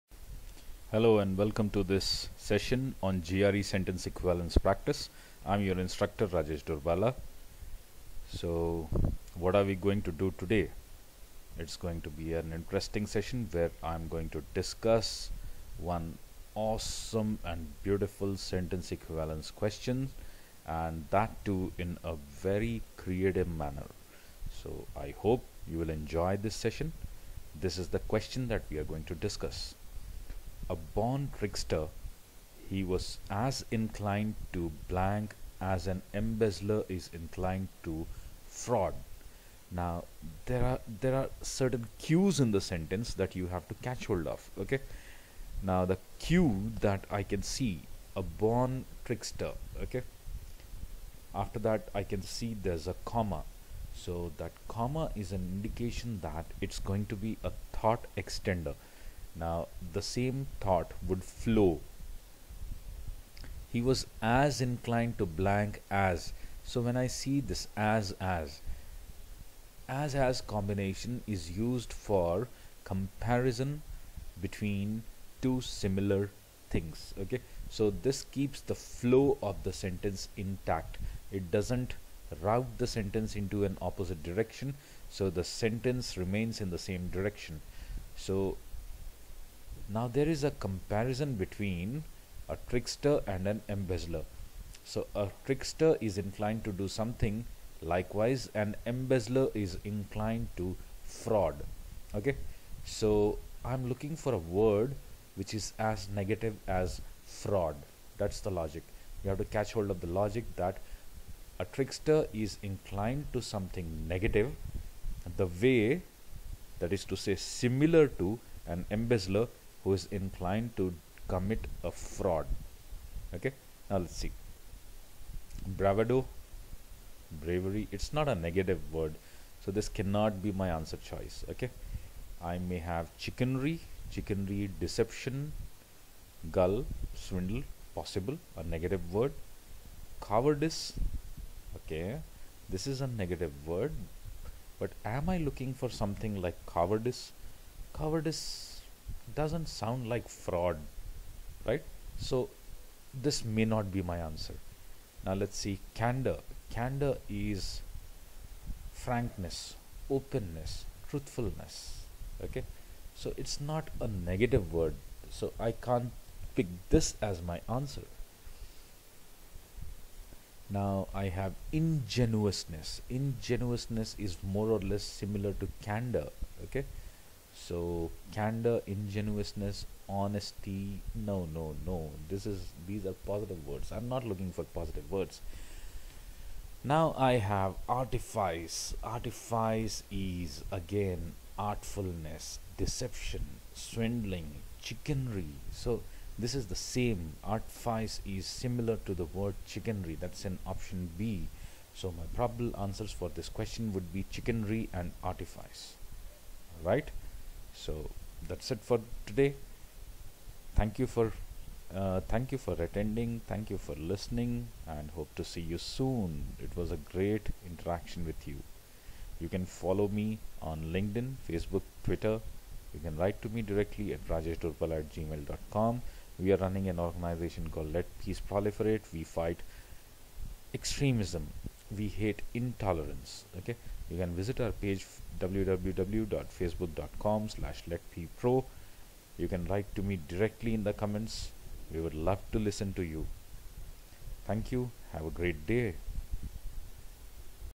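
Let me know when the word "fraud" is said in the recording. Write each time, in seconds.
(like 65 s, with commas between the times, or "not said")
38 s, 101 s, 107 s, 121 s, 150 s.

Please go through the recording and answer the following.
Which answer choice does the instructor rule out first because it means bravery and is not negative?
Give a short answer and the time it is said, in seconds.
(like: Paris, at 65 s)
bravado, at 125 s.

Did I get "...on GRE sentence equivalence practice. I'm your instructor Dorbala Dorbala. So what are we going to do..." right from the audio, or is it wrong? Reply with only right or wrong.
wrong.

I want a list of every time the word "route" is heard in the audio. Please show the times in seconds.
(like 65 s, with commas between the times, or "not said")
82 s.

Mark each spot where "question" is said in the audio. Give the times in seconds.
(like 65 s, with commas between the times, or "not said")
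19 s, 27 s, 203 s.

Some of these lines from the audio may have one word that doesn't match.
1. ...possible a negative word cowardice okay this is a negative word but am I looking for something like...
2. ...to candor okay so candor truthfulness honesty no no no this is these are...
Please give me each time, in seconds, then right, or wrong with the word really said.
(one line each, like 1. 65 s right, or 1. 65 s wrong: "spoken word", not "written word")
1. 137 s right
2. 175 s wrong: "ingenuousness", not "truthfulness".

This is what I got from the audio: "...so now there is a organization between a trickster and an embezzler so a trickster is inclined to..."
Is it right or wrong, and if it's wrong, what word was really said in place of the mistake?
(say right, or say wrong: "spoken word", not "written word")
wrong: "comparison", not "organization".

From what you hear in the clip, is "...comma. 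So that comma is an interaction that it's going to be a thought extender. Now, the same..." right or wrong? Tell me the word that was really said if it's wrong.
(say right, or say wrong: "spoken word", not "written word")
wrong: "indication", not "interaction".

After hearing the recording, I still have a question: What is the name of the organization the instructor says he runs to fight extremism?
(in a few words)
Let Peace Proliferate.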